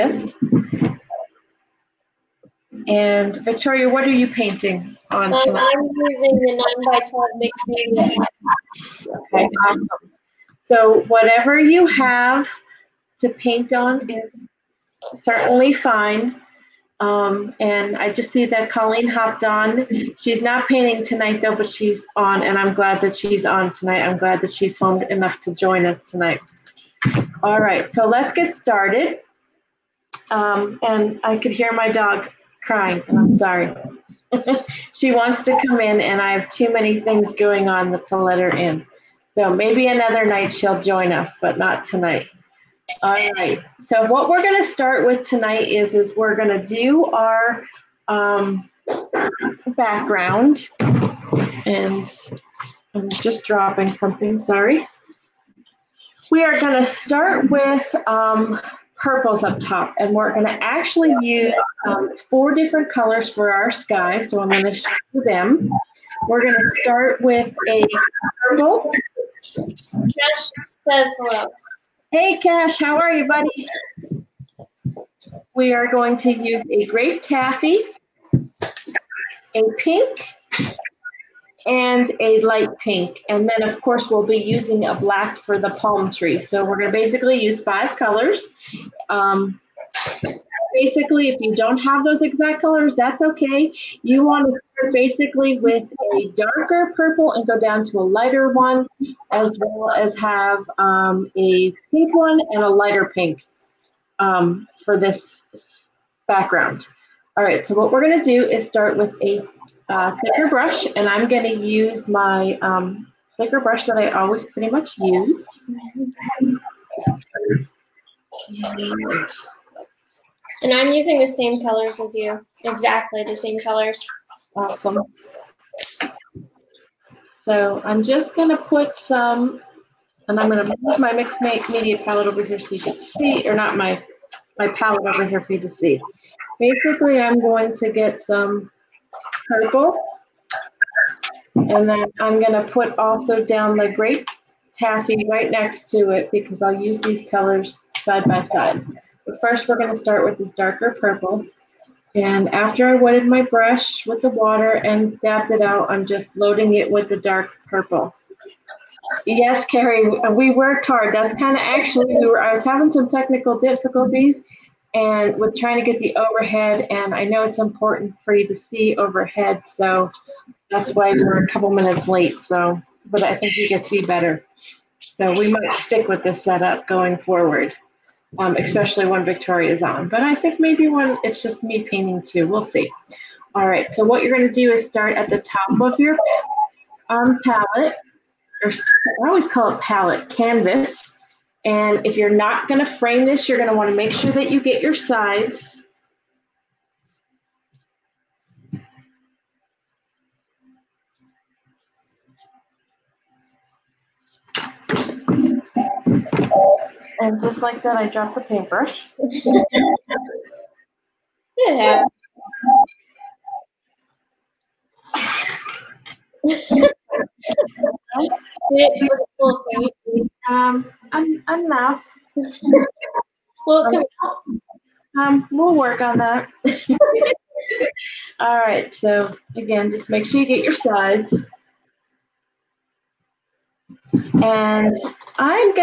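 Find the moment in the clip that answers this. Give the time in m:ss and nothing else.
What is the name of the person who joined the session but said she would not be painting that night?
0:18.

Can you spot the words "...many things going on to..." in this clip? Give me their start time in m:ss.
0:36.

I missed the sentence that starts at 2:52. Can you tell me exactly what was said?
So, but I think you can see better.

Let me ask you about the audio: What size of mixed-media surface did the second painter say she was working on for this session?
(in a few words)
9 by 12.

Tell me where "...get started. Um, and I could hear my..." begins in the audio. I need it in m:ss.
0:28.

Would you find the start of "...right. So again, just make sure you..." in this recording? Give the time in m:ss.
3:48.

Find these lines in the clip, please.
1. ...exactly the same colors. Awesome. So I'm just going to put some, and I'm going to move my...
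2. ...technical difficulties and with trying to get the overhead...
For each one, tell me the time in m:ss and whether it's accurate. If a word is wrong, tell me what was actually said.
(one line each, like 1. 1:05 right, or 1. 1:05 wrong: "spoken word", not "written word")
1. 2:02 right
2. 2:43 right.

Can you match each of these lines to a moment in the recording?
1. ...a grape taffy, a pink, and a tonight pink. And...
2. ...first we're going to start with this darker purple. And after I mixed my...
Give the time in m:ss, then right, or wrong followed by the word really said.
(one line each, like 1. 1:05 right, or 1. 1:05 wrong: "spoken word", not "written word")
1. 1:16 wrong: "light", not "tonight"
2. 2:29 wrong: "wetted", not "mixed".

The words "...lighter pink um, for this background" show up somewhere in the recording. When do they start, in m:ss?
1:42.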